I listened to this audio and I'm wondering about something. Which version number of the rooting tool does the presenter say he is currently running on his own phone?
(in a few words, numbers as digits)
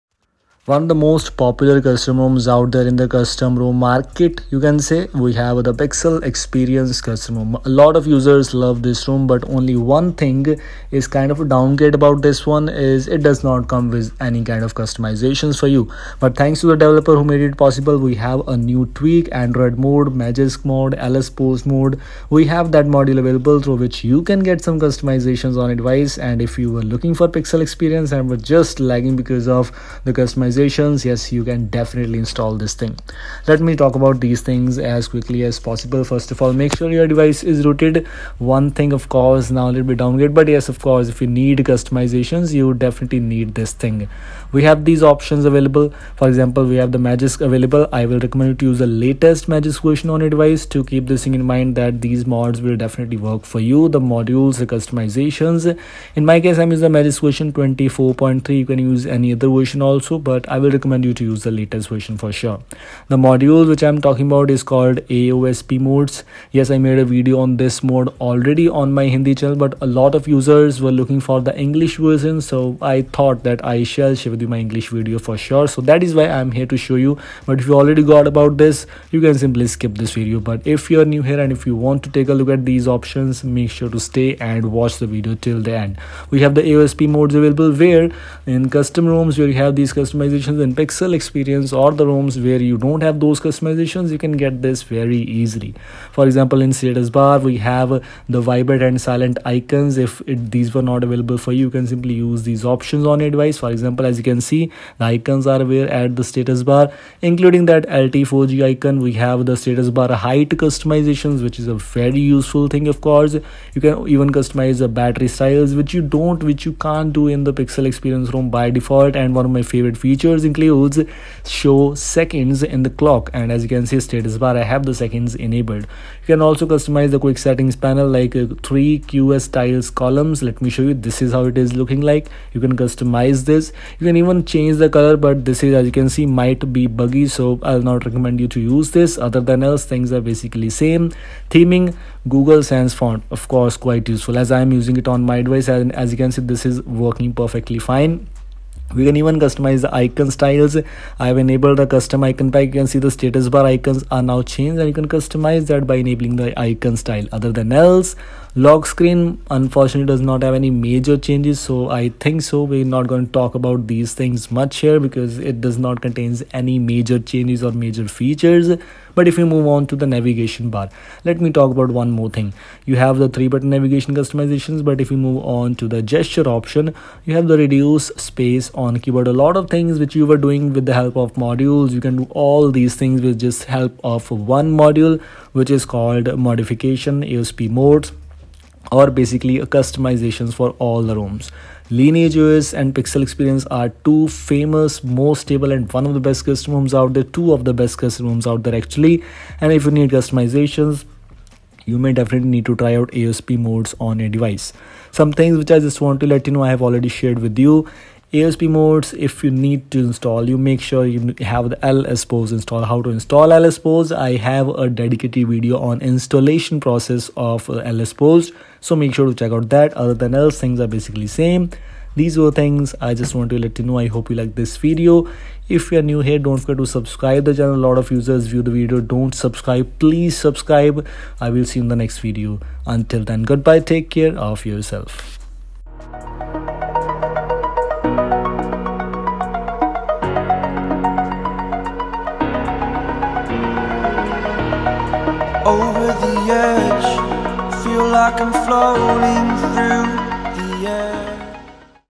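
24.3.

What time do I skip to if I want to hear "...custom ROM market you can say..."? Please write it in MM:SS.
00:03.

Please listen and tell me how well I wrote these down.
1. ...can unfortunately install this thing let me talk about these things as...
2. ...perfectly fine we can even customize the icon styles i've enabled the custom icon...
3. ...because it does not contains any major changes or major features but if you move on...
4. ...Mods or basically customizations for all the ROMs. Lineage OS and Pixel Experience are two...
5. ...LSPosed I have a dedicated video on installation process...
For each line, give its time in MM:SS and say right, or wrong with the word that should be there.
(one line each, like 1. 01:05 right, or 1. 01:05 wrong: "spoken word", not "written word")
1. 00:31 wrong: "definitely", not "unfortunately"
2. 02:27 right
3. 02:44 right
4. 03:07 right
5. 03:33 right.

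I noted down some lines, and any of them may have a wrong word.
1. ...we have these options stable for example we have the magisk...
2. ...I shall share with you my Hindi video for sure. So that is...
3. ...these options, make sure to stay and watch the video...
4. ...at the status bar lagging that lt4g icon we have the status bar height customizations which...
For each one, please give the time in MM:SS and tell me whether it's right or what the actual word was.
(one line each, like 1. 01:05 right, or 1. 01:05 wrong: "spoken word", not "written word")
1. 00:44 wrong: "available", not "stable"
2. 01:13 wrong: "English", not "Hindi"
3. 01:22 right
4. 01:45 wrong: "including", not "lagging".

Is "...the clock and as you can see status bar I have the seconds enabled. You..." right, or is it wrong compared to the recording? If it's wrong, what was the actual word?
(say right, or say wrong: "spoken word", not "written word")
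right.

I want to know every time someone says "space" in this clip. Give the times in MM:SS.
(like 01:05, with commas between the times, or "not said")
02:58.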